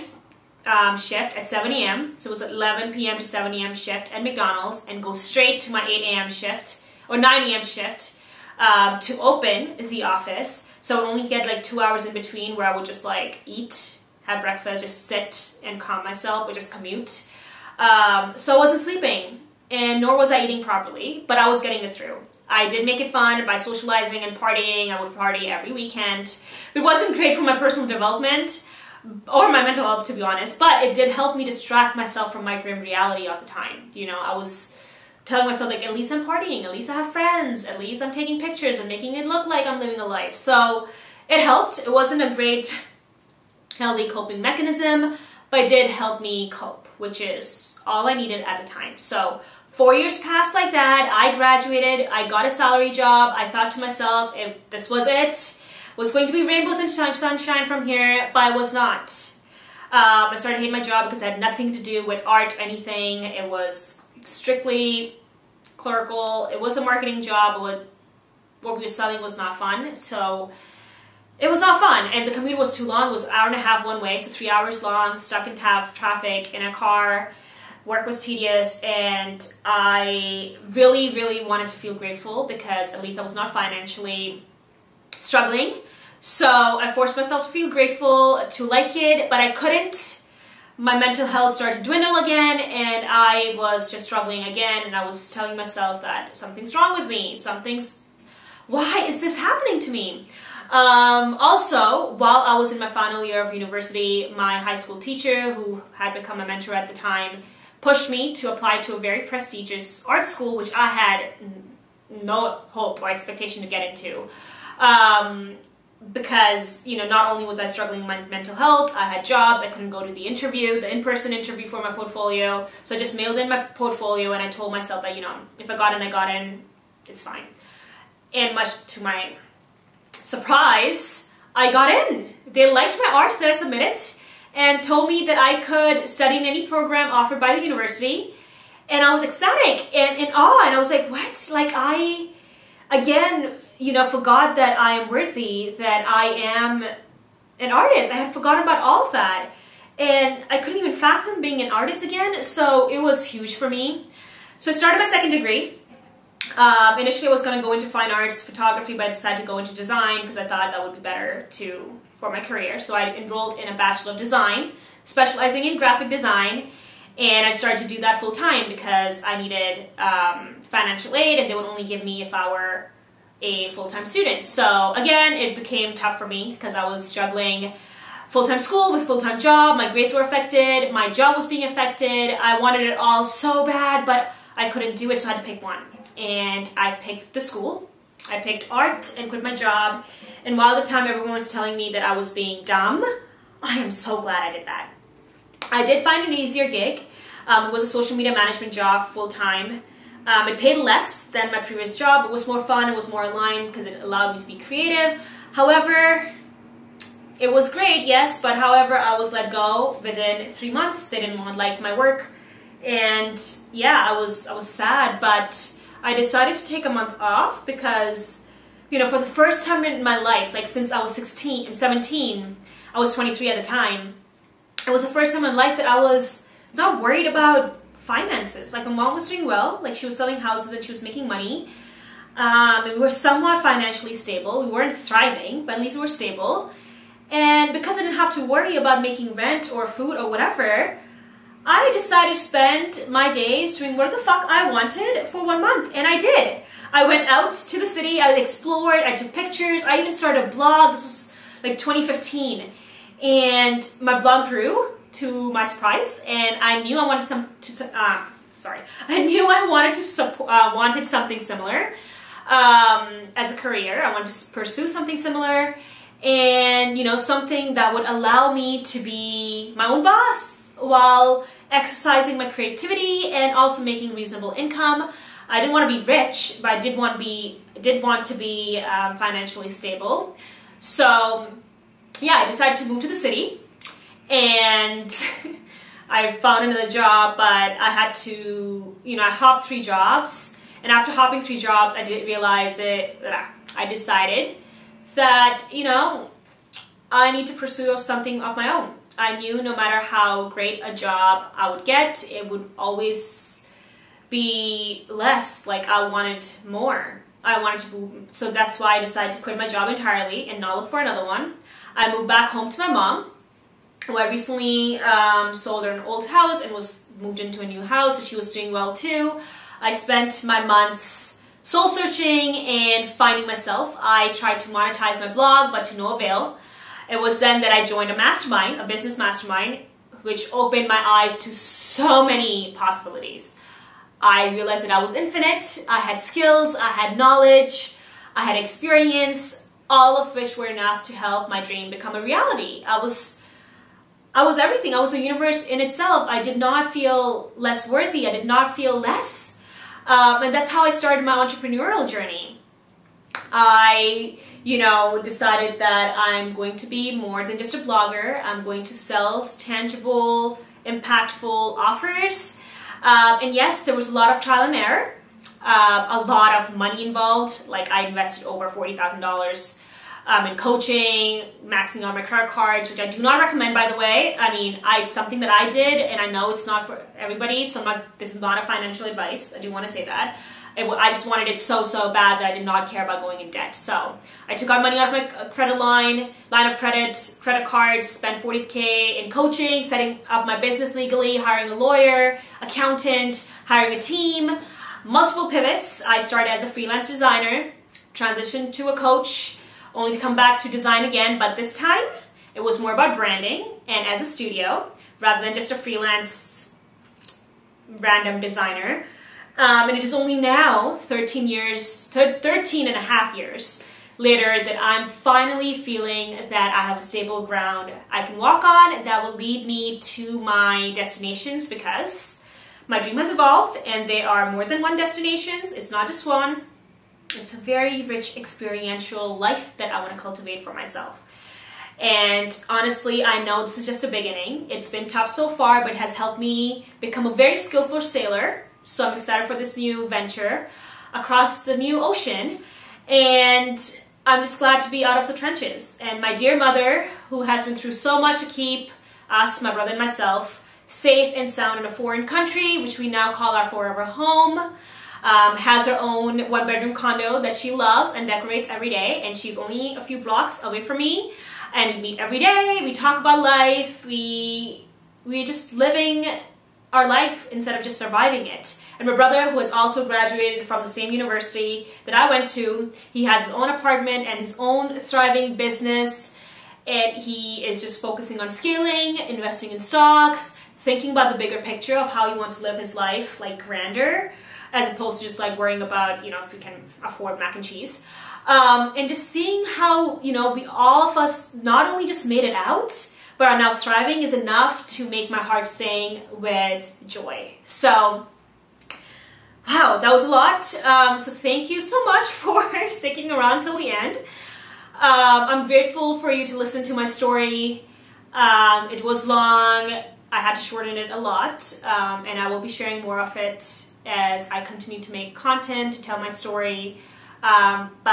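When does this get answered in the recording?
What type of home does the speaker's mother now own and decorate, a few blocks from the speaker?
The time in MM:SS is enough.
07:36.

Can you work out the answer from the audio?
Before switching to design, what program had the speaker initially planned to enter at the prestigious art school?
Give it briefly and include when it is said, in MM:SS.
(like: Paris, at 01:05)
Fine arts photography, at 02:37.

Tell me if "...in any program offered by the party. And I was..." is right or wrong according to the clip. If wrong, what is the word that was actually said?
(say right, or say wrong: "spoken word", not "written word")
wrong: "university", not "party".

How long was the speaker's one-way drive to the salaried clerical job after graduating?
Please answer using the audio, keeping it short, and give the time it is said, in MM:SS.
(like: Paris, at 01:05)
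An hour and a half, at 01:13.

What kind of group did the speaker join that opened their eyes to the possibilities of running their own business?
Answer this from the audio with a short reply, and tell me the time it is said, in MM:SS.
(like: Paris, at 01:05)
Business mastermind, at 05:28.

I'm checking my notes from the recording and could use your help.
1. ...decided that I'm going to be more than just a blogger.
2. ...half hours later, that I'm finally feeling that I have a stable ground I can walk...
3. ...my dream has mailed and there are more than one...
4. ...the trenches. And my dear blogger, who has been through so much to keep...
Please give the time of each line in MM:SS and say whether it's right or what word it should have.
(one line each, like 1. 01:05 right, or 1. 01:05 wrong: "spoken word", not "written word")
1. 05:55 right
2. 06:52 wrong: "years", not "hours"
3. 07:02 wrong: "evolved", not "mailed"
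4. 07:25 wrong: "mother", not "blogger".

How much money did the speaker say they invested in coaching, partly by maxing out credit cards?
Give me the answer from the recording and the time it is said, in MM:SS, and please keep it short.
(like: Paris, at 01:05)
$40,000, at 06:08.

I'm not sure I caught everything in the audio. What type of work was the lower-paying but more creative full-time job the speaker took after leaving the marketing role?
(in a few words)
Social media management.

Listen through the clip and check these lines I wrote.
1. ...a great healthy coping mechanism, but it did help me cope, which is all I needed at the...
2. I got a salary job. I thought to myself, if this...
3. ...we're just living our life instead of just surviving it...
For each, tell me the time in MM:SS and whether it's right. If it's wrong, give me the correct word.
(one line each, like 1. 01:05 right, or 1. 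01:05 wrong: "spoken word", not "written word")
1. 00:42 right
2. 00:52 right
3. 07:45 right.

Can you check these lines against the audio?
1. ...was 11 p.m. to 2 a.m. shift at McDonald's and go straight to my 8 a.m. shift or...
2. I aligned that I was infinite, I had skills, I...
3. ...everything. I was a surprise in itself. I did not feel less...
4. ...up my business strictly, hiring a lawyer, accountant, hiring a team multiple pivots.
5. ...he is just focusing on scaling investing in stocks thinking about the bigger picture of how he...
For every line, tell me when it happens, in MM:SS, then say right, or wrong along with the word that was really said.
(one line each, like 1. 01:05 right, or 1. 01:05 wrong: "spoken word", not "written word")
1. 00:02 wrong: "7", not "2"
2. 05:34 wrong: "realized", not "aligned"
3. 05:44 wrong: "universe", not "surprise"
4. 06:30 wrong: "legally", not "strictly"
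5. 07:57 right.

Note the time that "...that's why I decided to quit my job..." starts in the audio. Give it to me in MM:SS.
05:08.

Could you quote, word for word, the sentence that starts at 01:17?
Work was tedious, and I really, really wanted to feel grateful because at least I was not financially struggling.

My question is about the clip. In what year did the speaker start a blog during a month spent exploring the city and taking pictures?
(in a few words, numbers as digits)
2015.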